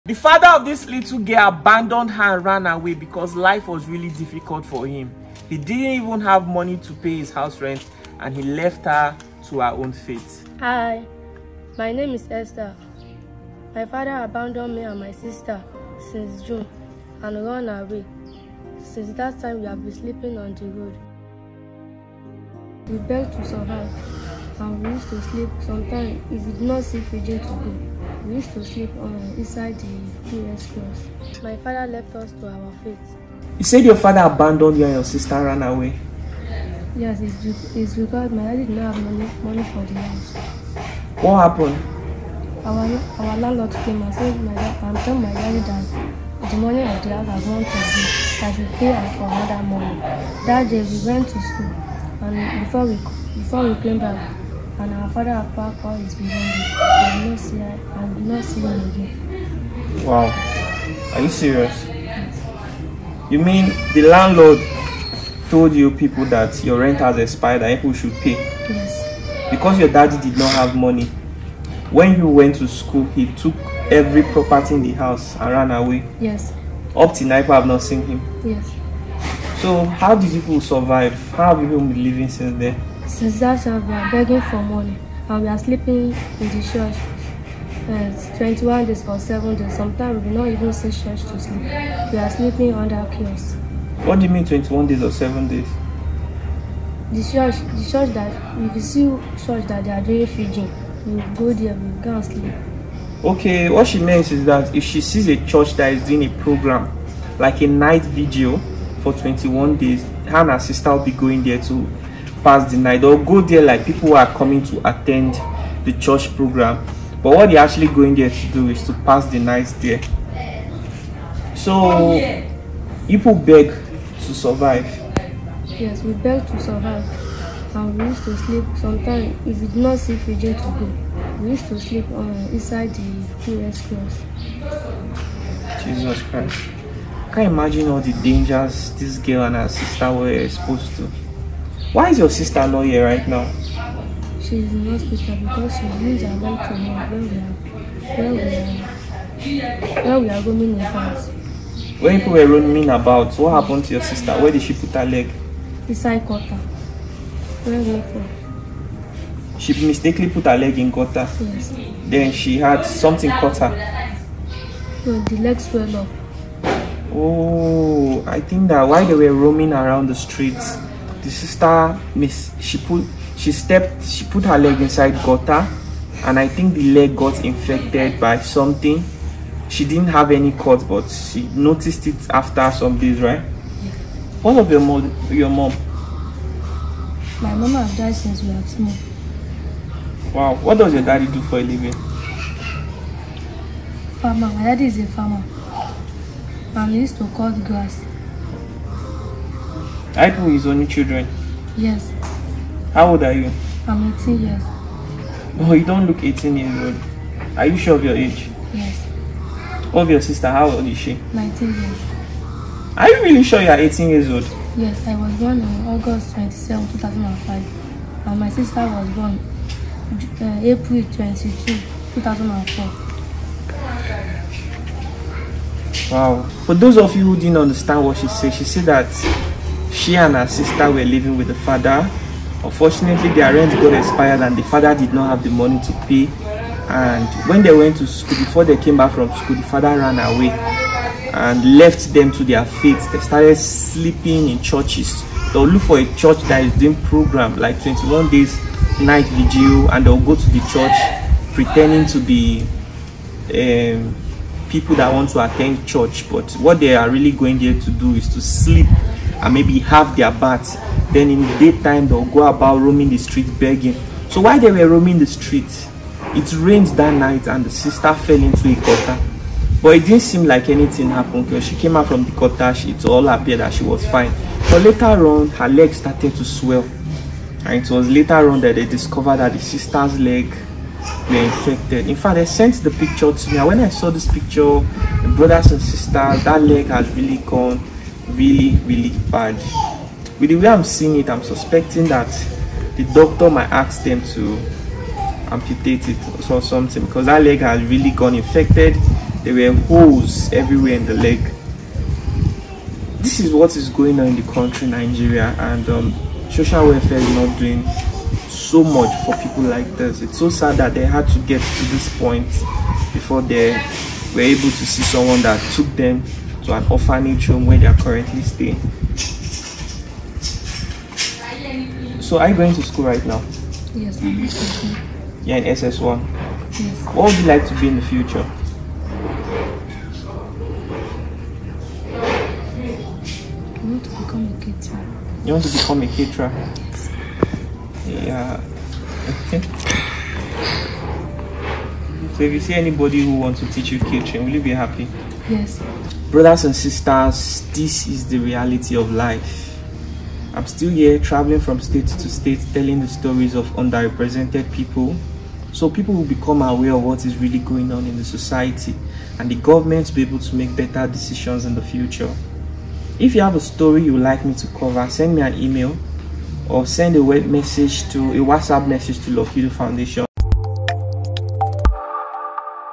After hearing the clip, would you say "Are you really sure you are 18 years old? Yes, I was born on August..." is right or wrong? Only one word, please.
right.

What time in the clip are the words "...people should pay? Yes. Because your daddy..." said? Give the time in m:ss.
1:07.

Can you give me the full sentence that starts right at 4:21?
Then in the daytime, they'll go about roaming the street begging.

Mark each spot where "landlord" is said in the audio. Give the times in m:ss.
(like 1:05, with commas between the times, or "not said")
0:43, 1:04.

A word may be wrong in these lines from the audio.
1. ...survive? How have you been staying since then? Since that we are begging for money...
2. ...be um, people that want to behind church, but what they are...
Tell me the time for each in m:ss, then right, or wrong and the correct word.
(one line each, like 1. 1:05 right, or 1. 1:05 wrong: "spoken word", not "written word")
1. 1:20 wrong: "living", not "staying"
2. 4:12 wrong: "attend", not "behind".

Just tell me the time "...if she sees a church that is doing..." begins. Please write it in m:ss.
1:44.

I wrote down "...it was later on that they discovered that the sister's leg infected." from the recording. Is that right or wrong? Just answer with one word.
right.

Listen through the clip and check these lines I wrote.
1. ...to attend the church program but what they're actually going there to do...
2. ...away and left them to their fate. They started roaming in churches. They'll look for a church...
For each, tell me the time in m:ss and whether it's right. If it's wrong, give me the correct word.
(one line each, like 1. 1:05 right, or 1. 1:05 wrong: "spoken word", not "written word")
1. 1:54 right
2. 4:00 wrong: "sleeping", not "roaming".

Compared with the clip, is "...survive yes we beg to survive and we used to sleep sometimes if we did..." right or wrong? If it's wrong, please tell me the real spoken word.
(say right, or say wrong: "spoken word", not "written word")
right.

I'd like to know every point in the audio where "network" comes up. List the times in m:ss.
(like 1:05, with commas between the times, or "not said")
not said.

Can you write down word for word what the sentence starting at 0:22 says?
We begged to survive and we used to sleep sometimes.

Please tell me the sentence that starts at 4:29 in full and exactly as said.
But it didn't seem like anything happened because she came out from the gutter, it all appeared that she was fine.